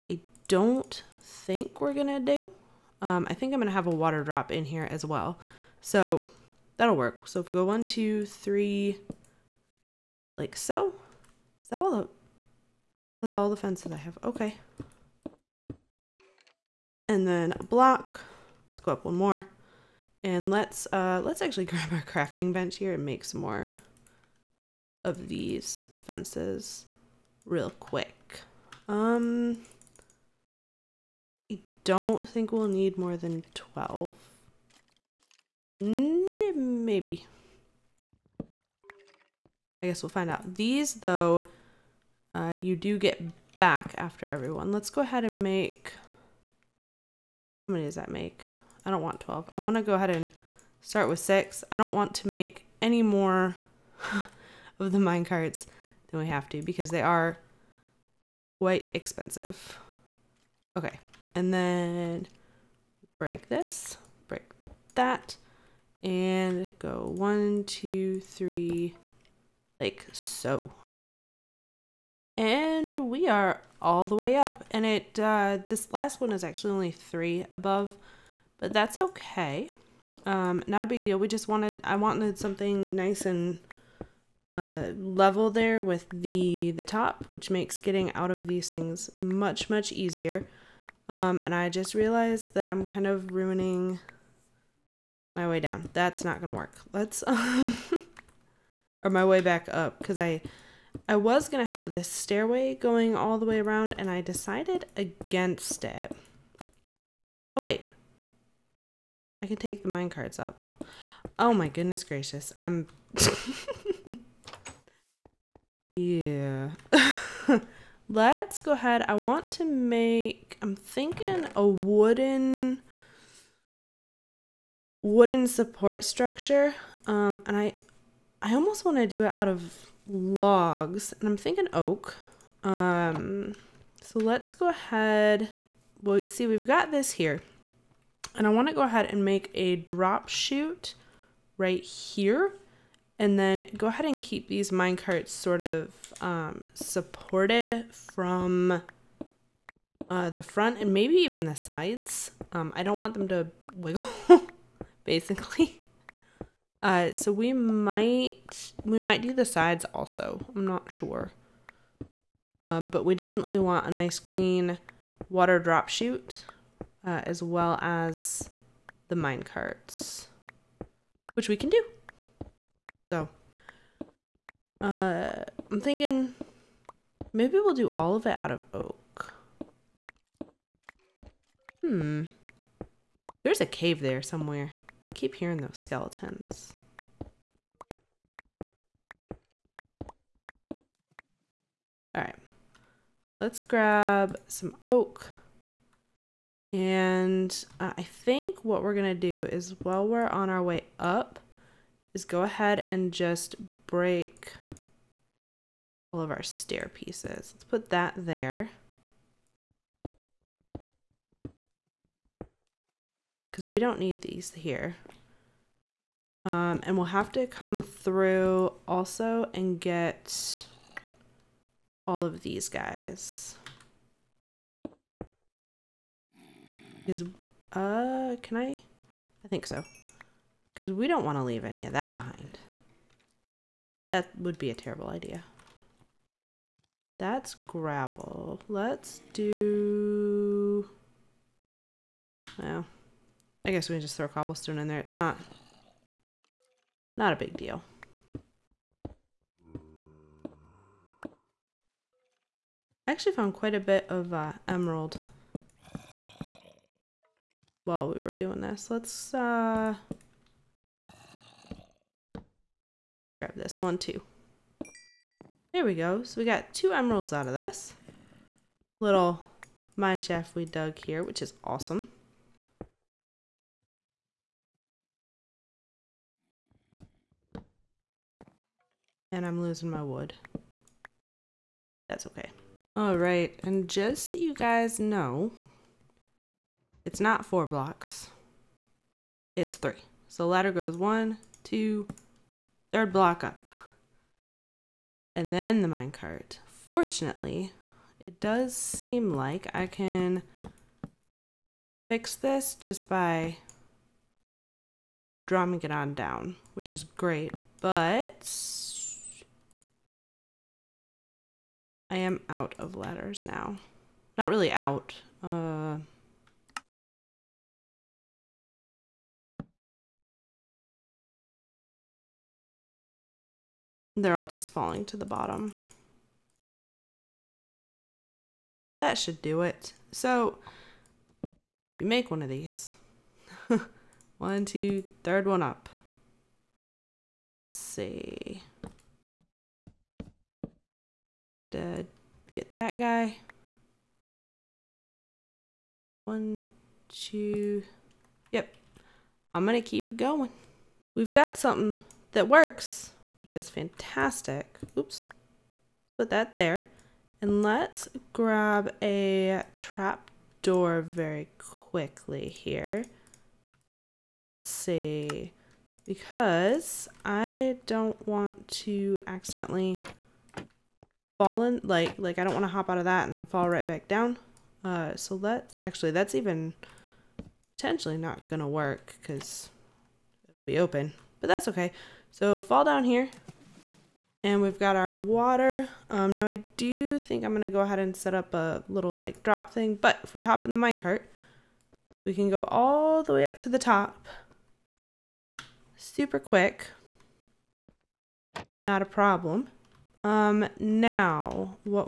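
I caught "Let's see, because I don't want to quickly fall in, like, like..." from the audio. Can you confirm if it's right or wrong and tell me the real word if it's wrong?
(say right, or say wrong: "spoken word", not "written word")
wrong: "accidentally", not "quickly".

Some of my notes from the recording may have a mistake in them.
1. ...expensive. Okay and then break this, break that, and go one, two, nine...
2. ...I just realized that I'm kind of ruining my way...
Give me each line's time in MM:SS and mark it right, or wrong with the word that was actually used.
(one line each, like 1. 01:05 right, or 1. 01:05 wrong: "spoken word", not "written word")
1. 00:58 wrong: "three", not "nine"
2. 01:31 right.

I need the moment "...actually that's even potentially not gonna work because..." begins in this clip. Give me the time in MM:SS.
06:15.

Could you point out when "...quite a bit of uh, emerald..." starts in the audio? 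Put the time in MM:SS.
04:13.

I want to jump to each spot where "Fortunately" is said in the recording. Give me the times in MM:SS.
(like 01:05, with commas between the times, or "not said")
04:56.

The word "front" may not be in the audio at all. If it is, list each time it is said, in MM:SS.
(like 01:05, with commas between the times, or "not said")
02:30.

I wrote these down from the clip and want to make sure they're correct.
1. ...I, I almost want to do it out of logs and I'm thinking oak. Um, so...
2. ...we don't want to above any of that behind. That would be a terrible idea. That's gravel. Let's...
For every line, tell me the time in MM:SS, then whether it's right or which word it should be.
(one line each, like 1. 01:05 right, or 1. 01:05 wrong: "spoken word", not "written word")
1. 02:07 right
2. 03:50 wrong: "leave", not "above".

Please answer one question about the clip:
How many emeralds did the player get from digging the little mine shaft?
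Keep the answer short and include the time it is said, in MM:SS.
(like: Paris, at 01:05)
2, at 04:26.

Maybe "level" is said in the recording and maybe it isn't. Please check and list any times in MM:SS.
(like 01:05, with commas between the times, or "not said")
01:24.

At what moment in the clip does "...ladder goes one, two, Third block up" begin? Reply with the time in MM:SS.
04:50.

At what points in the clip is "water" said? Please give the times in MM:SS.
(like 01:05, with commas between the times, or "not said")
00:03, 02:45, 06:25.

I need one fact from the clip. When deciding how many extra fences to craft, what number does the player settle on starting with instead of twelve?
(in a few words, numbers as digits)
6.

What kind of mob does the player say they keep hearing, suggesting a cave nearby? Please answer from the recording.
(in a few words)
skeletons.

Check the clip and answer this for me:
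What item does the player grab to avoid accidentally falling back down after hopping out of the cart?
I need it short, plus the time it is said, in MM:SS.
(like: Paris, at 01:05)
trap door, at 05:59.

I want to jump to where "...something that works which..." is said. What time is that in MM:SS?
05:51.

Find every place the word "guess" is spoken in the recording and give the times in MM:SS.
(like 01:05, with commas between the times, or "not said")
00:39, 04:03.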